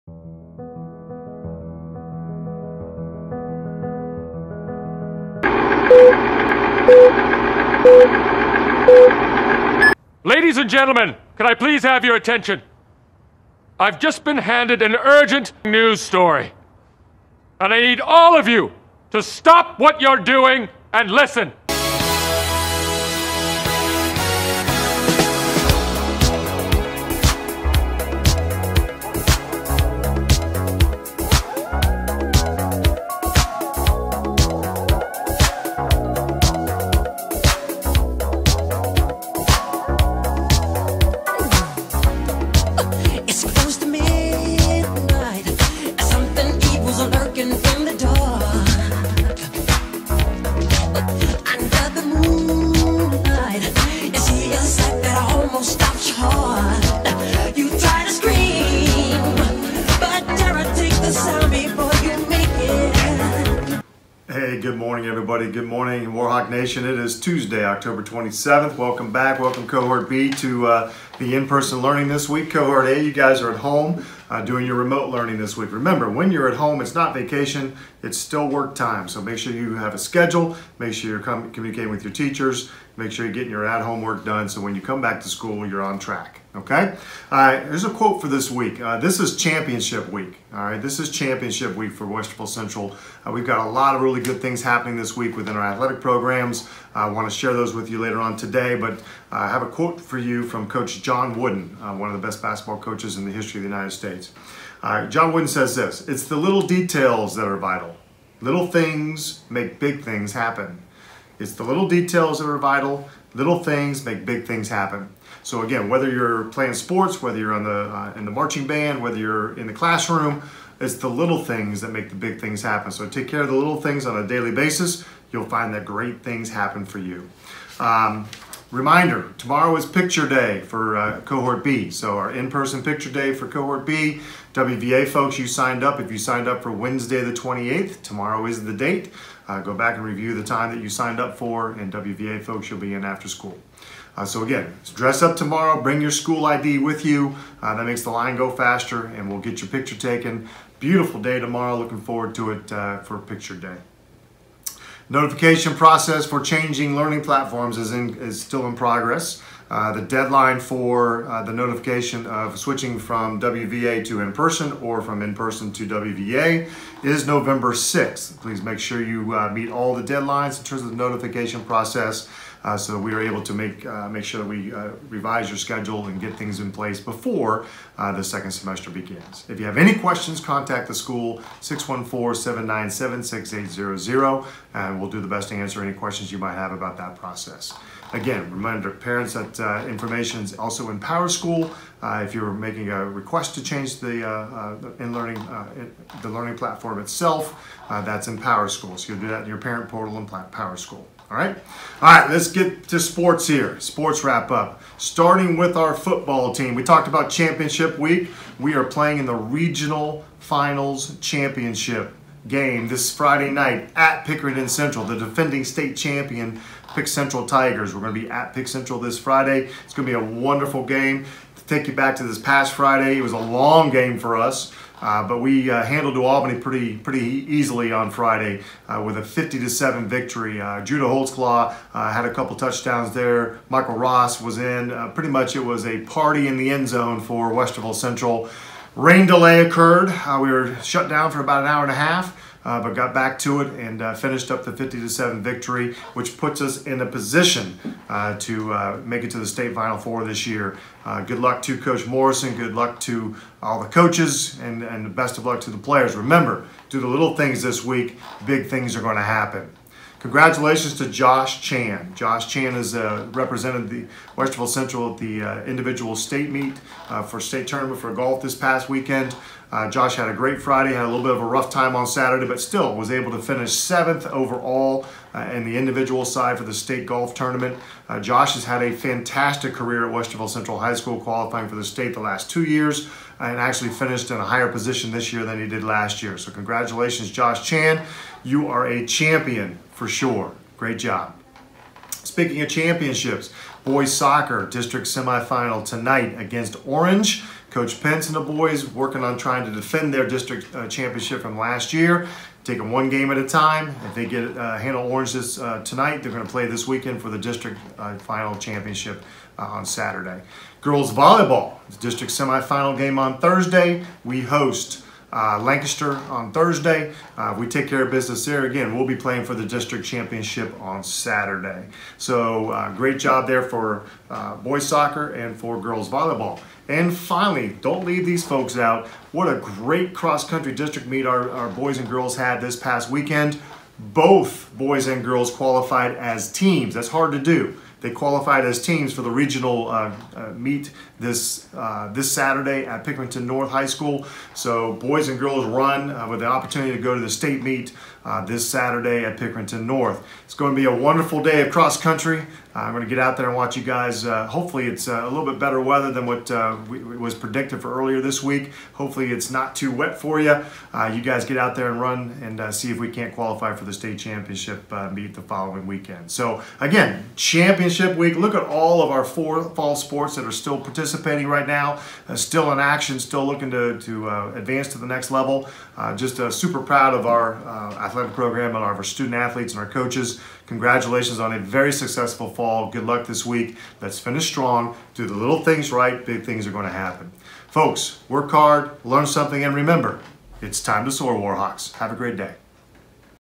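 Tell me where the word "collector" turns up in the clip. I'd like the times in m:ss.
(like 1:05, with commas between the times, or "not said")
not said.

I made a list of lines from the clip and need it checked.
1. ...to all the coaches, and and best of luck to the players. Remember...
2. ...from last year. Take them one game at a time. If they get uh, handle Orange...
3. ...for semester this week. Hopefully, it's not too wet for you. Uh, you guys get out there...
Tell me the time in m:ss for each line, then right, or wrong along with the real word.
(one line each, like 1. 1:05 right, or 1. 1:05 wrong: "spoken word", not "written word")
1. 4:13 right
2. 5:01 right
3. 5:57 wrong: "earlier", not "semester".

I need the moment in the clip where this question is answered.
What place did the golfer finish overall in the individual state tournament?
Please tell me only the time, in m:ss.
4:33.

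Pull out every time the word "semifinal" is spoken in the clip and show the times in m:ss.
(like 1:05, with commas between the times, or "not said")
4:55, 5:12.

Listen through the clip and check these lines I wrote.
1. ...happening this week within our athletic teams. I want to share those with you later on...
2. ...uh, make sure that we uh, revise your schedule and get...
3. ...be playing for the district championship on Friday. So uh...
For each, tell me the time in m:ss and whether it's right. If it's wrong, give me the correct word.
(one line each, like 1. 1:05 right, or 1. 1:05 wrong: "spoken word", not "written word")
1. 1:34 wrong: "programs", not "teams"
2. 2:53 right
3. 5:19 wrong: "Saturday", not "Friday".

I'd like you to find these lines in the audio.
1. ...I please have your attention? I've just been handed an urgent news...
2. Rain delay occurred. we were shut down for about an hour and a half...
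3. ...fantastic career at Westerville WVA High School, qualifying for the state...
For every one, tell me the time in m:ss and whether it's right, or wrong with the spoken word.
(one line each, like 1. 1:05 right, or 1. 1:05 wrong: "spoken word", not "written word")
1. 0:11 right
2. 3:58 right
3. 4:38 wrong: "Central", not "WVA".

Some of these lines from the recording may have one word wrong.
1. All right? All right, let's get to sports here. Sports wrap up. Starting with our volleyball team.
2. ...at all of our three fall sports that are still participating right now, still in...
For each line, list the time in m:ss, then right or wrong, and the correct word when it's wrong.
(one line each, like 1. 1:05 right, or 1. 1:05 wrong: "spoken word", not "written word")
1. 3:21 wrong: "football", not "volleyball"
2. 6:08 wrong: "four", not "three".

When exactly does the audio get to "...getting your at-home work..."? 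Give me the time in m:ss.
1:23.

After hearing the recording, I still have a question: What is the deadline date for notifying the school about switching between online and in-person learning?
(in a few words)
November 6th.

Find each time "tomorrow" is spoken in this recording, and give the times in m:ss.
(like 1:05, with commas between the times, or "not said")
2:09, 2:18, 2:25, 2:31.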